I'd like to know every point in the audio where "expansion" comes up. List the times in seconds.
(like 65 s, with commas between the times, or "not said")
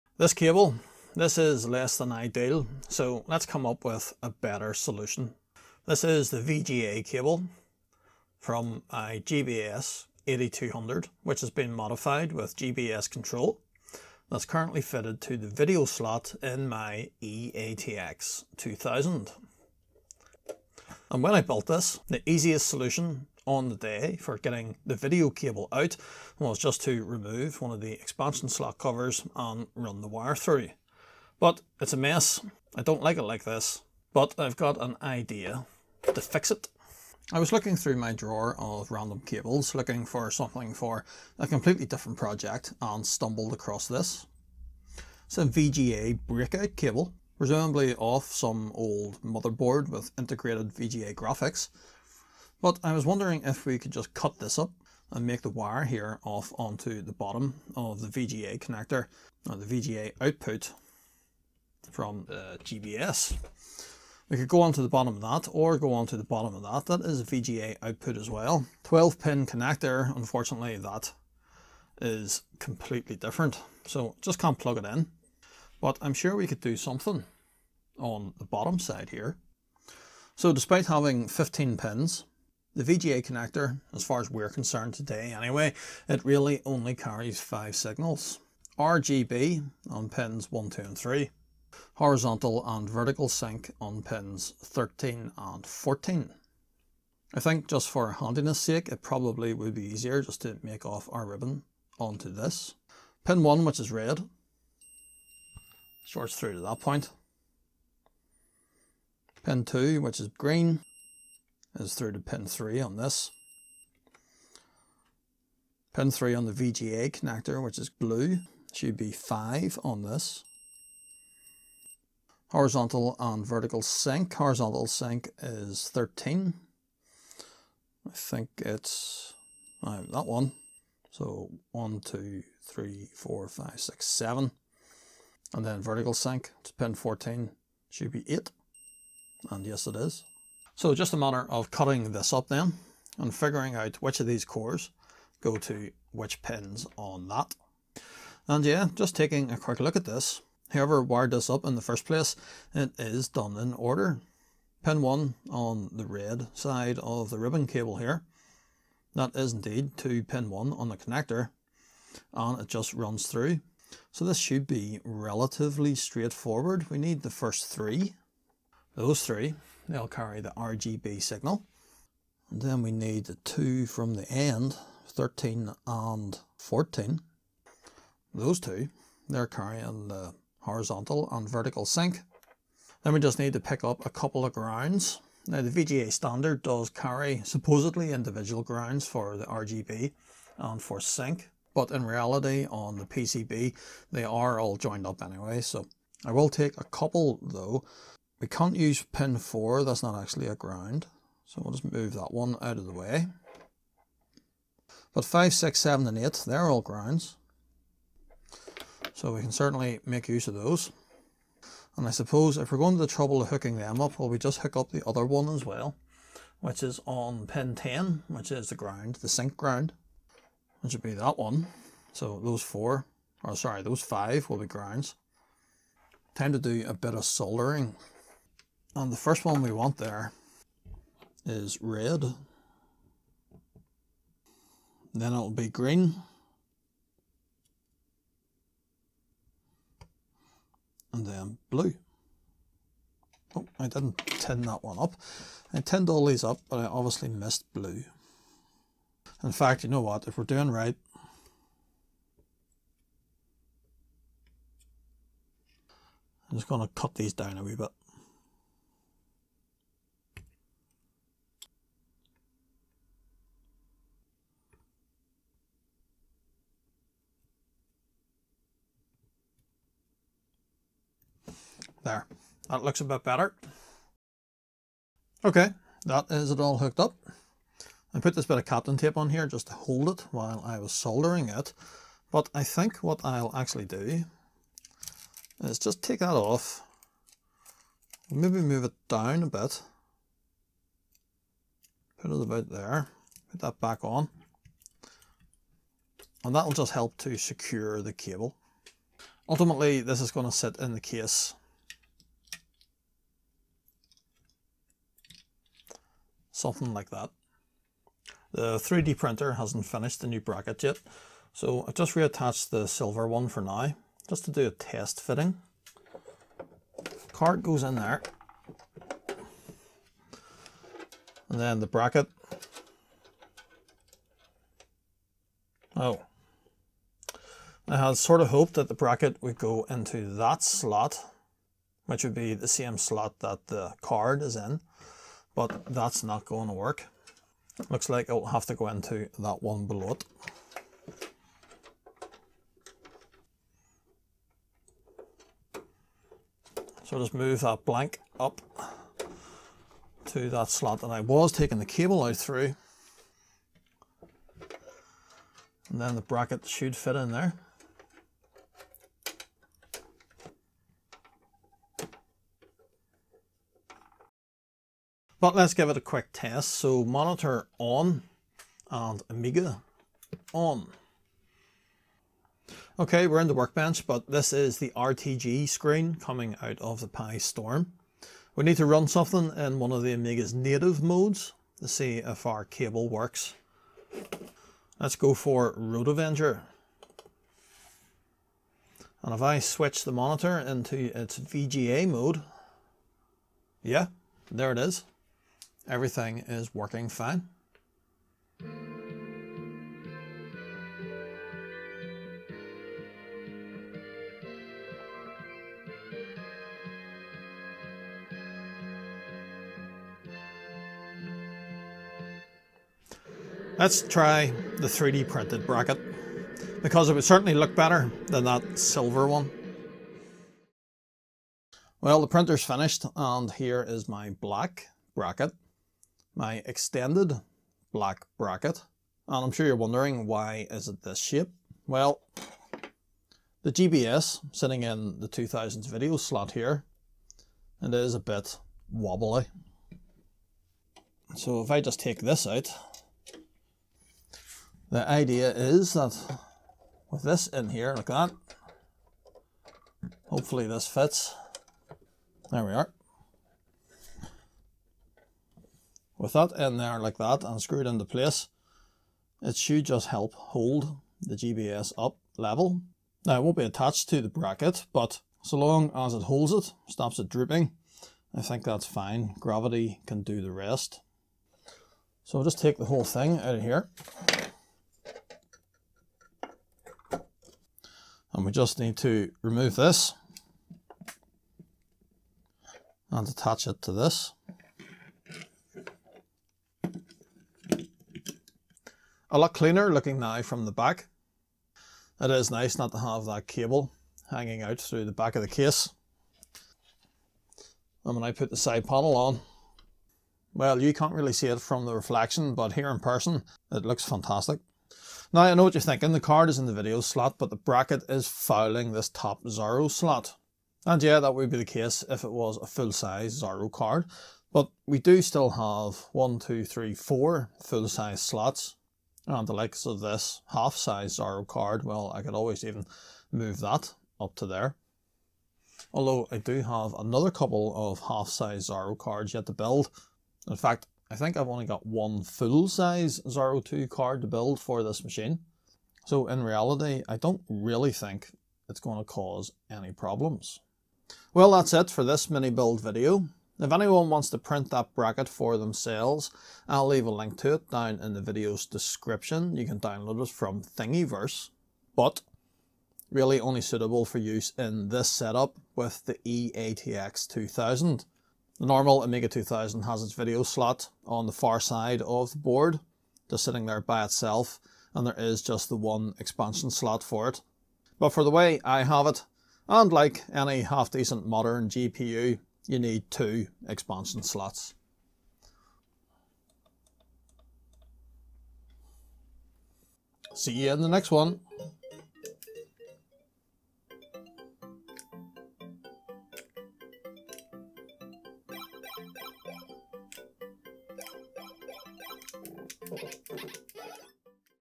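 27 s, 566 s, 573 s.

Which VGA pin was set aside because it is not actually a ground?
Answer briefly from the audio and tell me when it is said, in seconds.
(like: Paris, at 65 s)
4, at 199 s.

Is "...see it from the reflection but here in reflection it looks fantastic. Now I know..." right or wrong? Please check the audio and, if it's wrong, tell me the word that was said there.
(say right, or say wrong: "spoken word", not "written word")
wrong: "person", not "reflection".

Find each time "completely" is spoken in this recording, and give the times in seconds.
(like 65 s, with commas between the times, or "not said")
41 s, 72 s.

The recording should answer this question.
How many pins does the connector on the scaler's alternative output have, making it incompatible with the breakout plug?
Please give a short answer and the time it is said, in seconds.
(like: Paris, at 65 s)
12, at 68 s.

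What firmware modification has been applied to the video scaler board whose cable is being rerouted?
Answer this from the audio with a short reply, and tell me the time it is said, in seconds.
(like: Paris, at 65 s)
GBS control, at 12 s.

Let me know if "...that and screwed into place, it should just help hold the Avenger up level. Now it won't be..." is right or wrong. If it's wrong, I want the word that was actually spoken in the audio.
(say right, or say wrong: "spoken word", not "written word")
wrong: "GBS", not "Avenger".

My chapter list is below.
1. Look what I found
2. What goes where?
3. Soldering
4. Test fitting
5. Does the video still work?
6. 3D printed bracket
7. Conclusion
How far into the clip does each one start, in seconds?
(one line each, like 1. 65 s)
1. 36 s
2. 79 s
3. 228 s
4. 274 s
5. 364 s
6. 421 s
7. 541 s.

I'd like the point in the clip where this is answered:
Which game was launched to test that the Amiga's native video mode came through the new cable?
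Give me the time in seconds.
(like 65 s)
385 s.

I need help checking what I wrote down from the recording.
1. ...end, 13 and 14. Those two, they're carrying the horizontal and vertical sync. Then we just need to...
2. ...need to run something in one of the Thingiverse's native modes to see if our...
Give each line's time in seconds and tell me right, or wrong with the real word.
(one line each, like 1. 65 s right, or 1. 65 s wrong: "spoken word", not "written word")
1. 174 s right
2. 378 s wrong: "Amiga", not "Thingiverse".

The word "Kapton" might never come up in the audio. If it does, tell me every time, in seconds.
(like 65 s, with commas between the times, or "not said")
278 s.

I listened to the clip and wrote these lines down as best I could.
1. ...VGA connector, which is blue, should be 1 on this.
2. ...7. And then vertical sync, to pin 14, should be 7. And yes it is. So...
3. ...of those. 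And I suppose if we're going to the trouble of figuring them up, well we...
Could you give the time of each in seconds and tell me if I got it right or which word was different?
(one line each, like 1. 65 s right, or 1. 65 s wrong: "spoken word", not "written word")
1. 116 s wrong: "5", not "1"
2. 134 s wrong: "8", not "7"
3. 210 s wrong: "hooking", not "figuring".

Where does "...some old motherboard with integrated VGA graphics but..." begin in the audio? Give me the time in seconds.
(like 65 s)
48 s.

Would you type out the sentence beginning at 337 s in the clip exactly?
Looks like it'll have to go into that one below it.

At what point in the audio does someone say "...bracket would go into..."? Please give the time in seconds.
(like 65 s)
328 s.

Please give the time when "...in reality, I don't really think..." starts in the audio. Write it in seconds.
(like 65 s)
536 s.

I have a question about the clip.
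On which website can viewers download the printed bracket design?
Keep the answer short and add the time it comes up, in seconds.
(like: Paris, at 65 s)
Thingiverse, at 550 s.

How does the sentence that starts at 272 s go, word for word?
There, that looks a bit better.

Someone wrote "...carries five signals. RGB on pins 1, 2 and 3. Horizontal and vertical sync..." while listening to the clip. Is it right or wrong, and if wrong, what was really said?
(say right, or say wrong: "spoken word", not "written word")
right.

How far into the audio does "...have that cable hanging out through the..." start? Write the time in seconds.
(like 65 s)
492 s.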